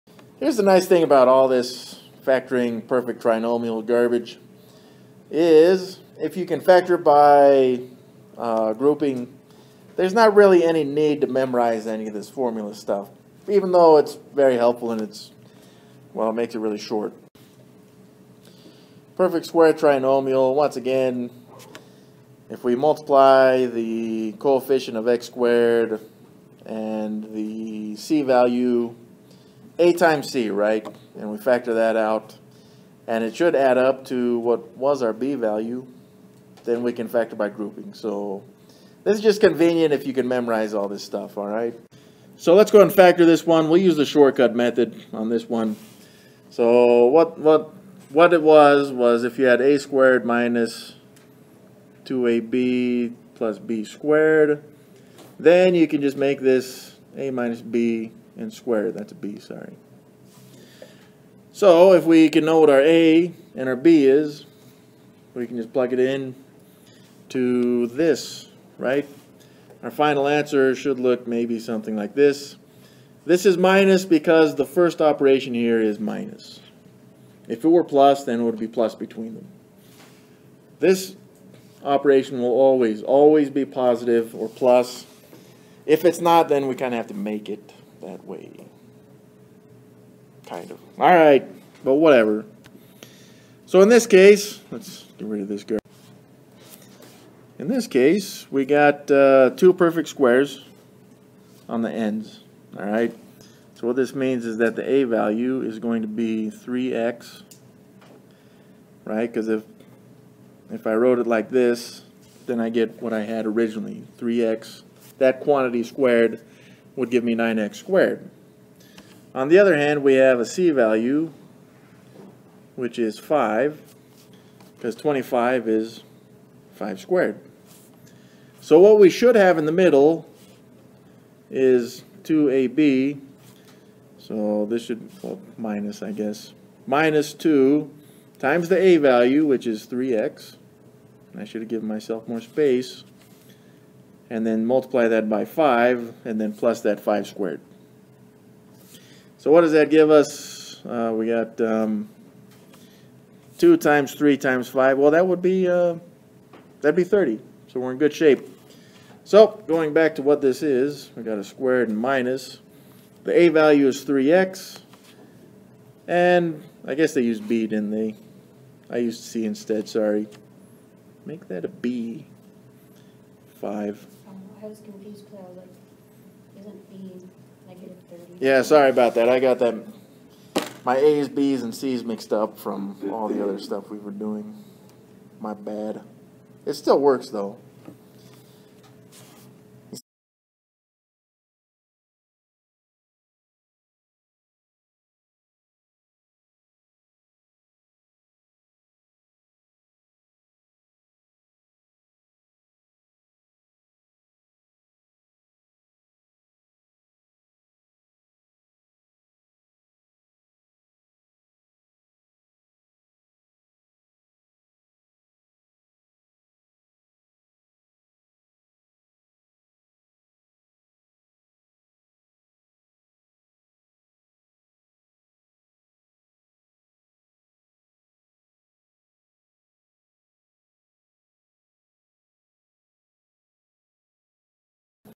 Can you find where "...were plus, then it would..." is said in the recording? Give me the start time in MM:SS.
01:17.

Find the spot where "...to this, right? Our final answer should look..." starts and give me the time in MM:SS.
01:07.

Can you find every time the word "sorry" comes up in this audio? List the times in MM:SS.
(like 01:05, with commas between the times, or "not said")
00:59, 02:49, 02:58.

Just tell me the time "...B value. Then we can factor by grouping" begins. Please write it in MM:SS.
00:35.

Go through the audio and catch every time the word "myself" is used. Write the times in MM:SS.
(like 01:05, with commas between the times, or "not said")
02:21.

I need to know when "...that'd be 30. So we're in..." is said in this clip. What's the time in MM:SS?
02:36.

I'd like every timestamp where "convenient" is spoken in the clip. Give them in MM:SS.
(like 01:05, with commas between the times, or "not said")
00:39.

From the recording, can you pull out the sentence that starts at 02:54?
I was confused because I was like, isn't B negative 30?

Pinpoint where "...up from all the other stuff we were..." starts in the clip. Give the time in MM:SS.
03:02.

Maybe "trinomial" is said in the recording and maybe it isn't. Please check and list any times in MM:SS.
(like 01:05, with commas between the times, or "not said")
00:03, 00:19.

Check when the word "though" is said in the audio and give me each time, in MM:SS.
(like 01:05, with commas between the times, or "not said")
00:13, 03:07.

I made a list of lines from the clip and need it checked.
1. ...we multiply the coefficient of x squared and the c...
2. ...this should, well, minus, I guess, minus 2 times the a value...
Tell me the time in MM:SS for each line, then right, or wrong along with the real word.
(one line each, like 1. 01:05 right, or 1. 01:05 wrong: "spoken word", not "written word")
1. 00:22 right
2. 02:14 right.